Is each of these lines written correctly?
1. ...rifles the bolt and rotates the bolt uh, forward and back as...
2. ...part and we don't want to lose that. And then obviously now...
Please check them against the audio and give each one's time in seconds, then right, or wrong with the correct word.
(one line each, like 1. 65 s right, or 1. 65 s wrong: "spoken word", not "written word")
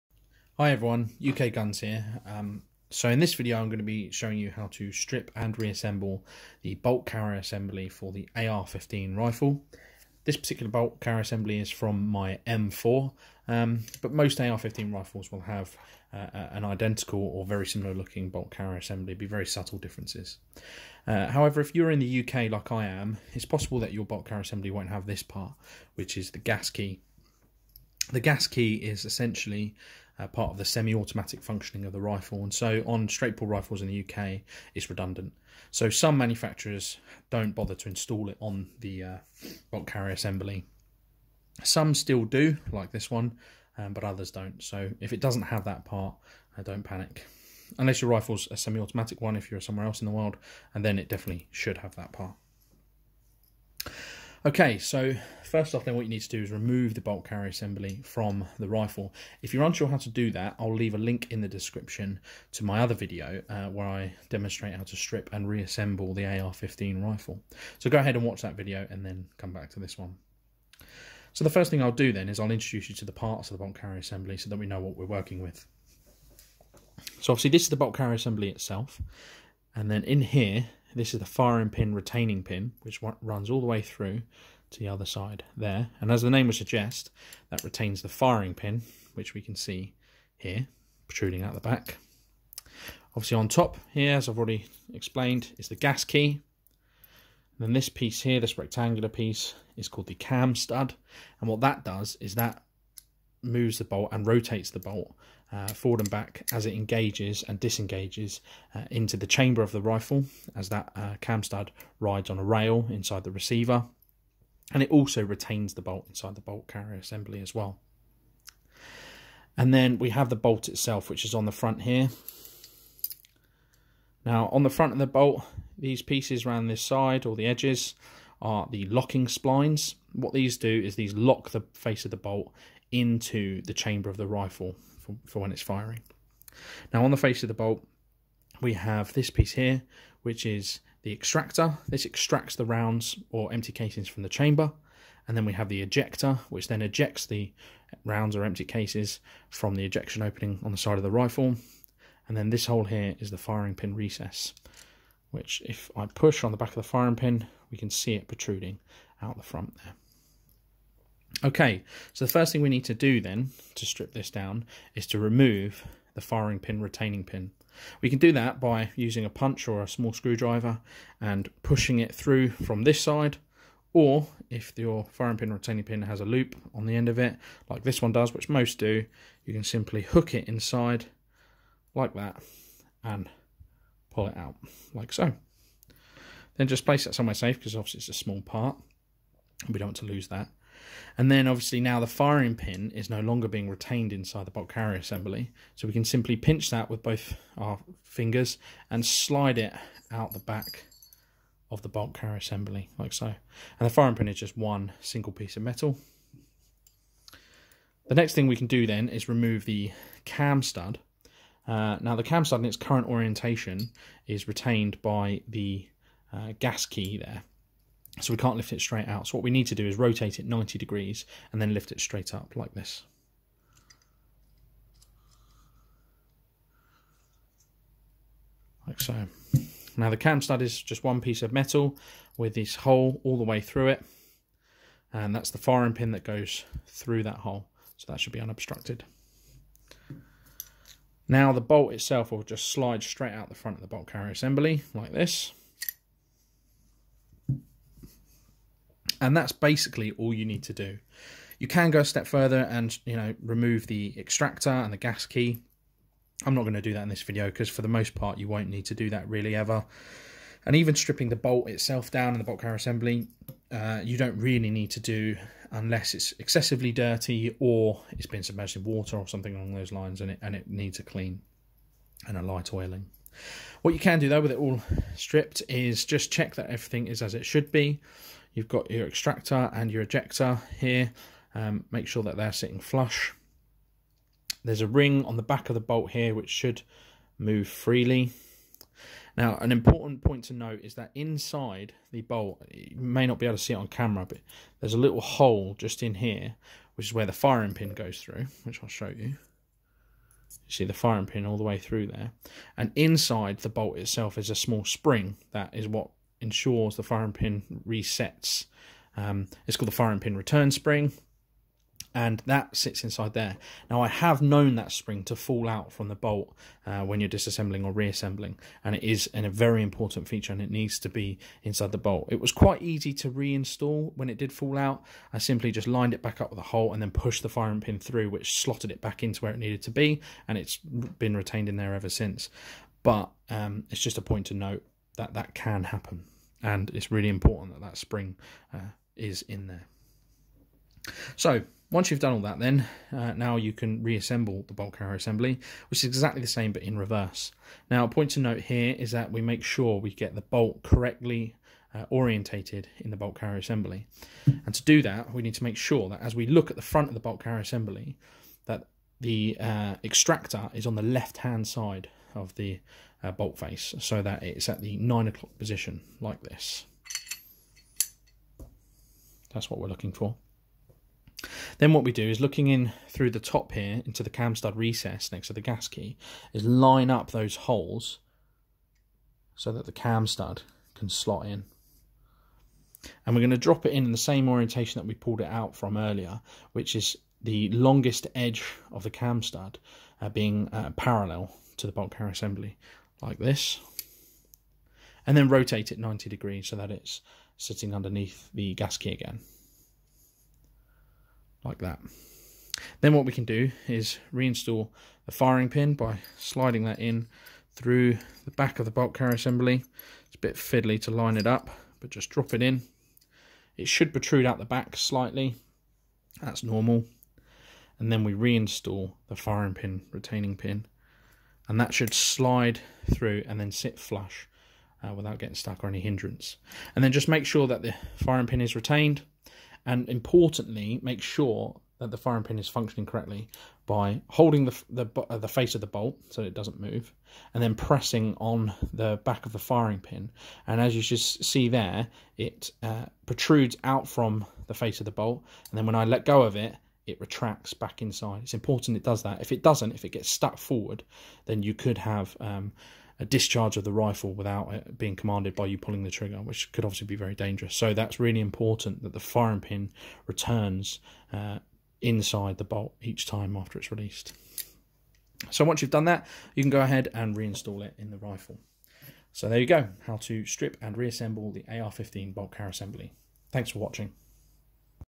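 1. 103 s wrong: "moves", not "rifles"
2. 188 s right.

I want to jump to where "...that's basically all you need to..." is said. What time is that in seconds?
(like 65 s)
249 s.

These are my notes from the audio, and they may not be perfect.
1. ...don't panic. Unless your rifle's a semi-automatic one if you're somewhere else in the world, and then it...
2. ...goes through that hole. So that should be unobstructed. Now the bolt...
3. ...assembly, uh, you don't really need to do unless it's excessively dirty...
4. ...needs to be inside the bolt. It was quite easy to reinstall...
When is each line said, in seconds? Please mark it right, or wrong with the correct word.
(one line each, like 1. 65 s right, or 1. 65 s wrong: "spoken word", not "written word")
1. 46 s right
2. 236 s right
3. 262 s right
4. 320 s right.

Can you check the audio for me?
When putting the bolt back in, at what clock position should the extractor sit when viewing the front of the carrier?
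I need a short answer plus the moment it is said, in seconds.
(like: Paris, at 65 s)
9 o'clock, at 364 s.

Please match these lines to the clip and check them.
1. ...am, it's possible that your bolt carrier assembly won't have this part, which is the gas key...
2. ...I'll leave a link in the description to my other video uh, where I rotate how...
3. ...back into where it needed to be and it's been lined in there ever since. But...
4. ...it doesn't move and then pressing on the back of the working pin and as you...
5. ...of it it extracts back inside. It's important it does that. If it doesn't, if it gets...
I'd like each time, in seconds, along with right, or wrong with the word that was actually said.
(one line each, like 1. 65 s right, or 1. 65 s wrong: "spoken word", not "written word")
1. 22 s right
2. 60 s wrong: "demonstrate", not "rotate"
3. 329 s wrong: "retained", not "lined"
4. 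436 s wrong: "firing", not "working"
5. 446 s wrong: "retracts", not "extracts".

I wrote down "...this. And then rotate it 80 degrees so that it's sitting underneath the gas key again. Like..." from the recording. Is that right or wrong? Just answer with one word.
wrong.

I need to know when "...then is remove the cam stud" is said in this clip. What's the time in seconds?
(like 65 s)
208 s.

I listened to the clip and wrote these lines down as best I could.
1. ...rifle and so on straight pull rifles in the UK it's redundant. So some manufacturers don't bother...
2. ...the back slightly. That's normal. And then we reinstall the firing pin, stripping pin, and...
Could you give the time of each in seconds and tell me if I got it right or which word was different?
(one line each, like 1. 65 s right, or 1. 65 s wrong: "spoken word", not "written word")
1. 32 s right
2. 414 s wrong: "retaining", not "stripping".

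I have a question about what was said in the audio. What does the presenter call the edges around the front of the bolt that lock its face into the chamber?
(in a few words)
locking splines.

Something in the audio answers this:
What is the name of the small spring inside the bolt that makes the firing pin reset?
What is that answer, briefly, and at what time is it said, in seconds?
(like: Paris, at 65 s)
firing pin return spring, at 309 s.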